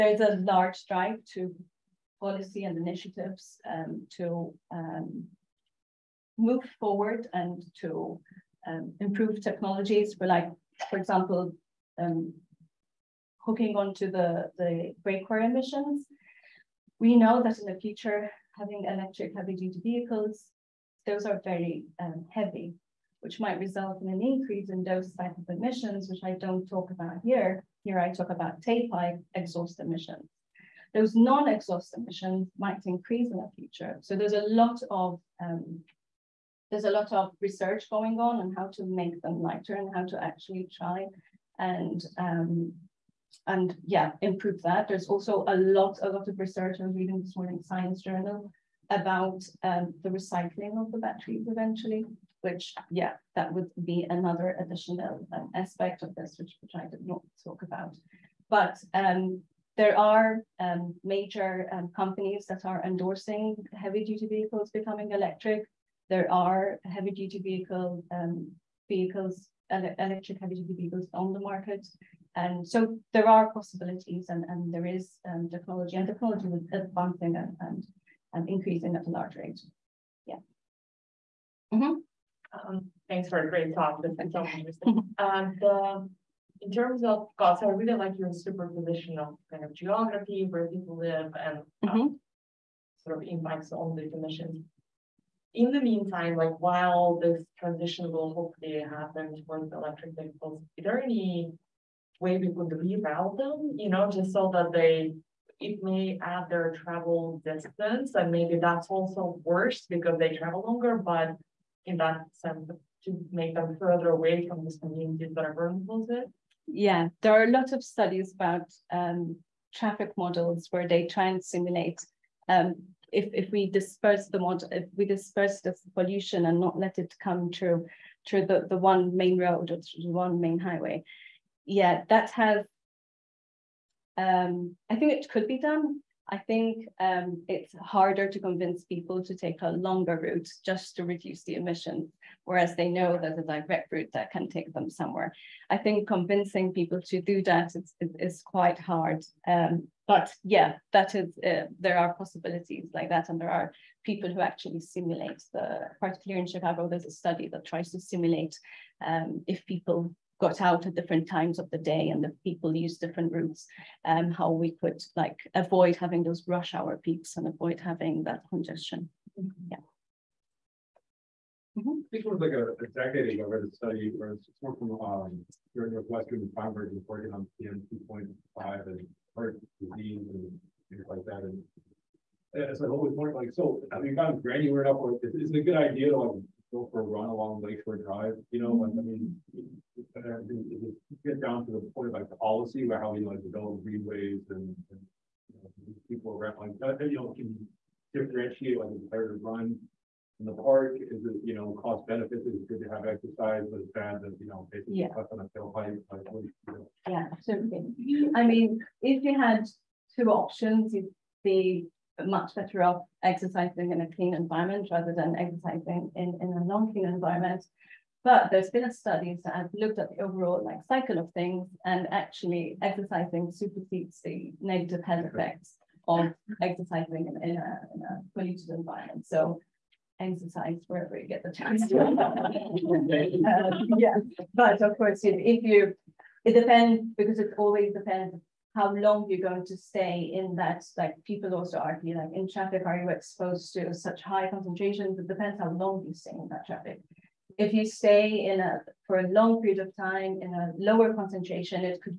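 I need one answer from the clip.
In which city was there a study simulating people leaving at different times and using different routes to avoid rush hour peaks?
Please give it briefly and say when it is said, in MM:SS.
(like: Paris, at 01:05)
Chicago, at 02:36.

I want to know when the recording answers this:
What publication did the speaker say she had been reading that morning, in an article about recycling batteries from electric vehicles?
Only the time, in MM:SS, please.
00:47.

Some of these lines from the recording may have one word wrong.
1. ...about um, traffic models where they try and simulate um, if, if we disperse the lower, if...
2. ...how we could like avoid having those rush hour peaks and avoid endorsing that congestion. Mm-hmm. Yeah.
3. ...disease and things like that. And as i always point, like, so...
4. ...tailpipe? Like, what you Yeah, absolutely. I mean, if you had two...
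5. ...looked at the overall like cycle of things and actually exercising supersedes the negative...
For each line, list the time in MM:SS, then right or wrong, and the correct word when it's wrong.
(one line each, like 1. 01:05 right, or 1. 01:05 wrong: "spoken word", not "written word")
1. 01:58 wrong: "water", not "lower"
2. 02:44 wrong: "having", not "endorsing"
3. 02:59 right
4. 03:25 right
5. 03:39 right.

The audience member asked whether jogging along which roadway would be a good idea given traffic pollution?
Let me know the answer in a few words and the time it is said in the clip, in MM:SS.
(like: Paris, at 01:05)
Lakeshore Drive, at 03:07.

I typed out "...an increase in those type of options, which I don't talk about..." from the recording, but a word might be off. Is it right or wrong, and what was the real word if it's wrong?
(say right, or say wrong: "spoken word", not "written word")
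wrong: "emissions", not "options".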